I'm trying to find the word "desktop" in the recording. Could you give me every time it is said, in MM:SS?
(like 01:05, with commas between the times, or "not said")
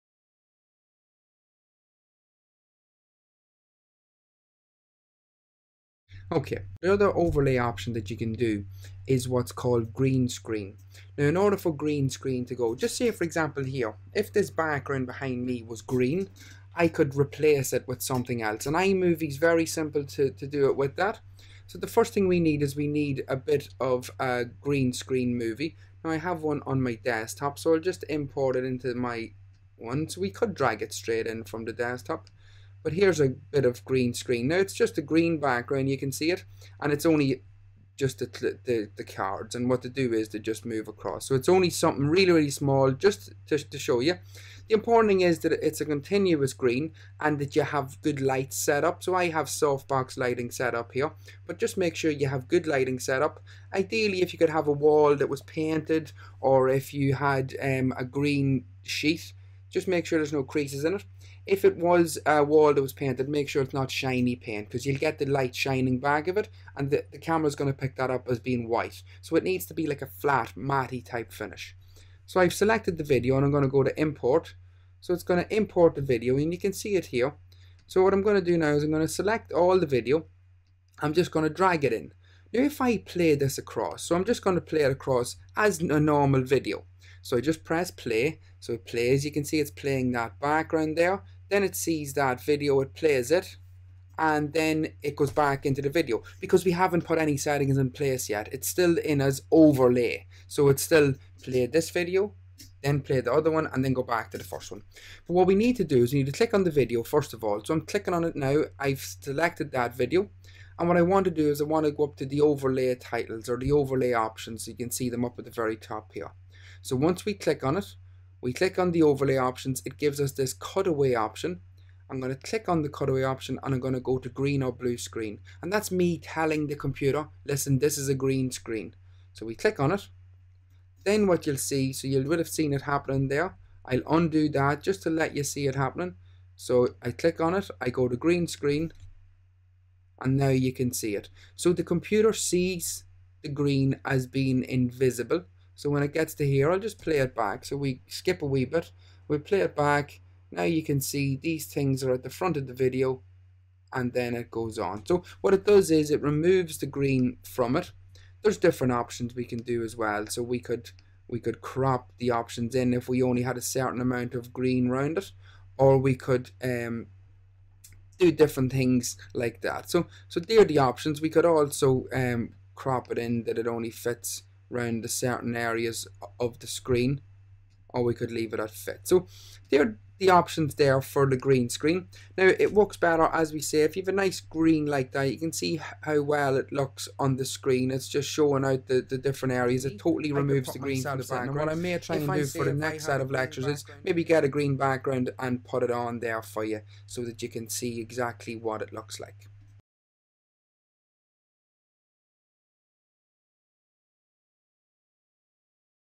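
00:26, 00:31.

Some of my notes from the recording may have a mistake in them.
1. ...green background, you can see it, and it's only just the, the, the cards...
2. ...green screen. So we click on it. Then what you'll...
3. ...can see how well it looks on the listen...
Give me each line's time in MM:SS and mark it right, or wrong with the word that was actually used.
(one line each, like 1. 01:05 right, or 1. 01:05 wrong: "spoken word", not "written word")
1. 00:35 right
2. 02:08 right
3. 03:05 wrong: "screen", not "listen".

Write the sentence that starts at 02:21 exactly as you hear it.
So the computer sees the green as being invisible.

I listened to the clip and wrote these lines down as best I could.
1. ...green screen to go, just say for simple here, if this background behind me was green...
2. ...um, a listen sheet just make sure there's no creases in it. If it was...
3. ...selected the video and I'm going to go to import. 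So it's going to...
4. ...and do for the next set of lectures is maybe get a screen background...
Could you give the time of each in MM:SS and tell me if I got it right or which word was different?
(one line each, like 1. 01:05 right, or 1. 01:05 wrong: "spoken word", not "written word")
1. 00:11 wrong: "example", not "simple"
2. 00:57 wrong: "green", not "listen"
3. 01:12 right
4. 03:12 wrong: "green", not "screen".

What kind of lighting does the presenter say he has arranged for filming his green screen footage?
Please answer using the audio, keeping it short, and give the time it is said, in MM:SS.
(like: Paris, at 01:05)
Softbox lighting, at 00:49.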